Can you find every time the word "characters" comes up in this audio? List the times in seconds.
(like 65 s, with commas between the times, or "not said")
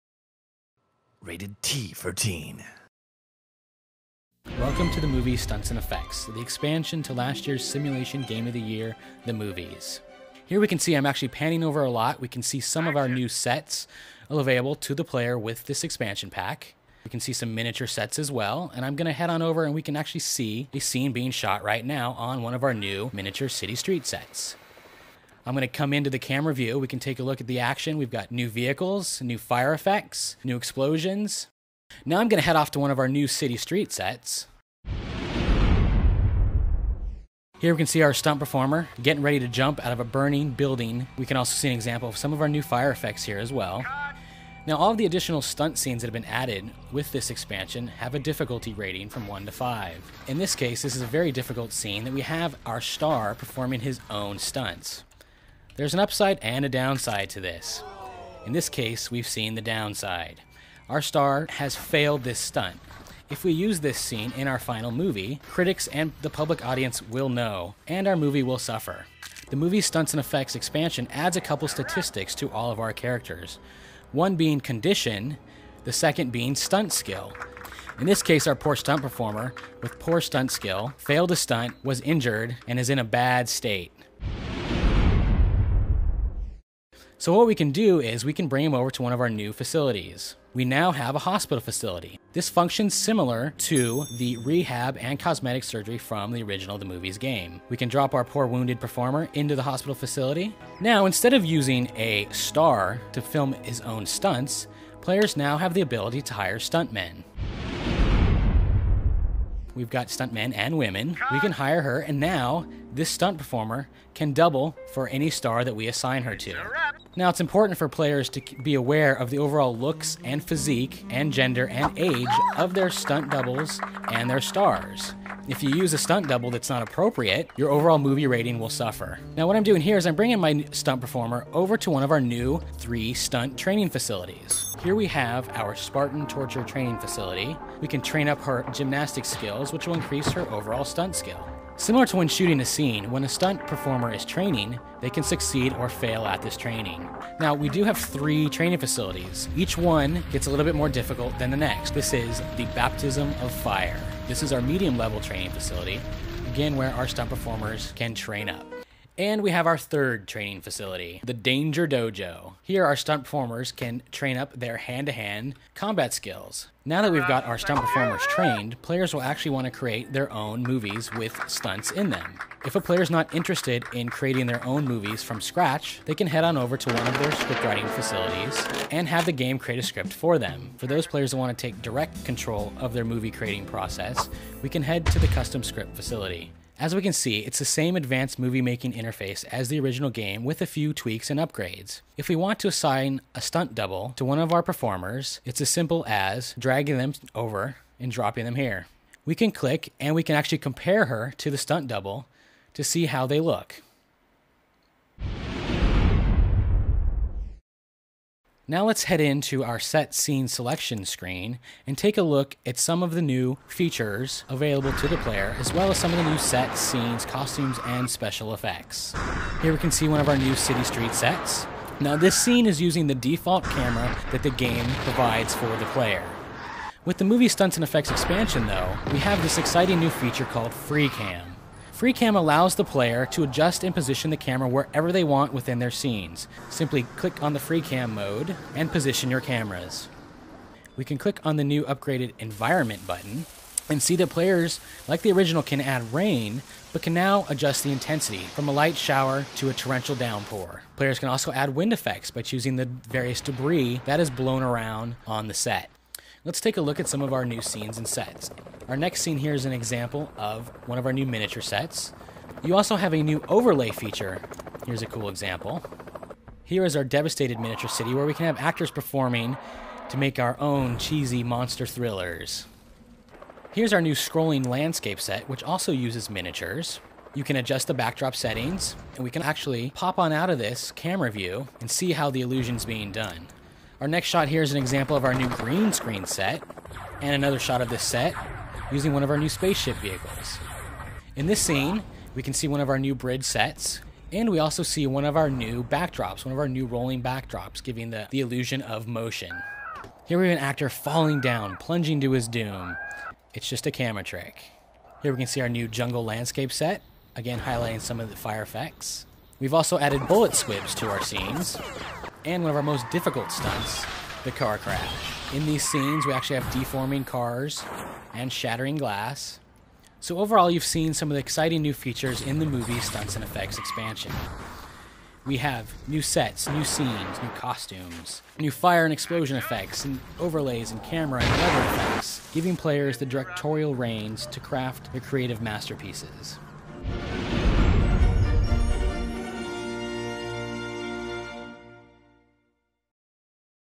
72 s.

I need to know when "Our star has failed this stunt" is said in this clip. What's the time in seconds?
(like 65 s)
60 s.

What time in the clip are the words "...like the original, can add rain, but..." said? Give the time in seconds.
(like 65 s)
245 s.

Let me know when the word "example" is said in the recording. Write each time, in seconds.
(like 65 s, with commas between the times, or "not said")
41 s, 259 s, 265 s, 284 s.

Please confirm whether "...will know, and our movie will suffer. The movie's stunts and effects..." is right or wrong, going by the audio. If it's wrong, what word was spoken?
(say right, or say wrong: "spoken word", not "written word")
right.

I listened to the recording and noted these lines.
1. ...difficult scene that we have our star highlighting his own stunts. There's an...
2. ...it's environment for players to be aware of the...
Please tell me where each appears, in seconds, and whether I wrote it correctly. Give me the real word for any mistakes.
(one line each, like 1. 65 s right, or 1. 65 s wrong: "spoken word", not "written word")
1. 51 s wrong: "performing", not "highlighting"
2. 117 s wrong: "important", not "environment".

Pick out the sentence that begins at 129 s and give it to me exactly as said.
Now, what I'm doing here is I'm bringing my stunt performer over to one of our new three stunt training facilities.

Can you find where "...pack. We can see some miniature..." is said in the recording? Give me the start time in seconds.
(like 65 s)
16 s.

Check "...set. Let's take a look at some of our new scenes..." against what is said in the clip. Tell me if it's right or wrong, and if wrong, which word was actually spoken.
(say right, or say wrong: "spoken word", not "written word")
right.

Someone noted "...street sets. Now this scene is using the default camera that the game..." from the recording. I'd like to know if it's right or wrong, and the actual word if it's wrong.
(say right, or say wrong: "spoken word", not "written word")
right.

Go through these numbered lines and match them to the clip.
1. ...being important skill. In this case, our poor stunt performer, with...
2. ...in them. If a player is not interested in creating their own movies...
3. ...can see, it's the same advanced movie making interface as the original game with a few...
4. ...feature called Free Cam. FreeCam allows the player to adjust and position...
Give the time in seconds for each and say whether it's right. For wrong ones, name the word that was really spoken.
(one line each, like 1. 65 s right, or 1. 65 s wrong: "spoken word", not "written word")
1. 76 s wrong: "stunt", not "important"
2. 171 s right
3. 187 s right
4. 230 s right.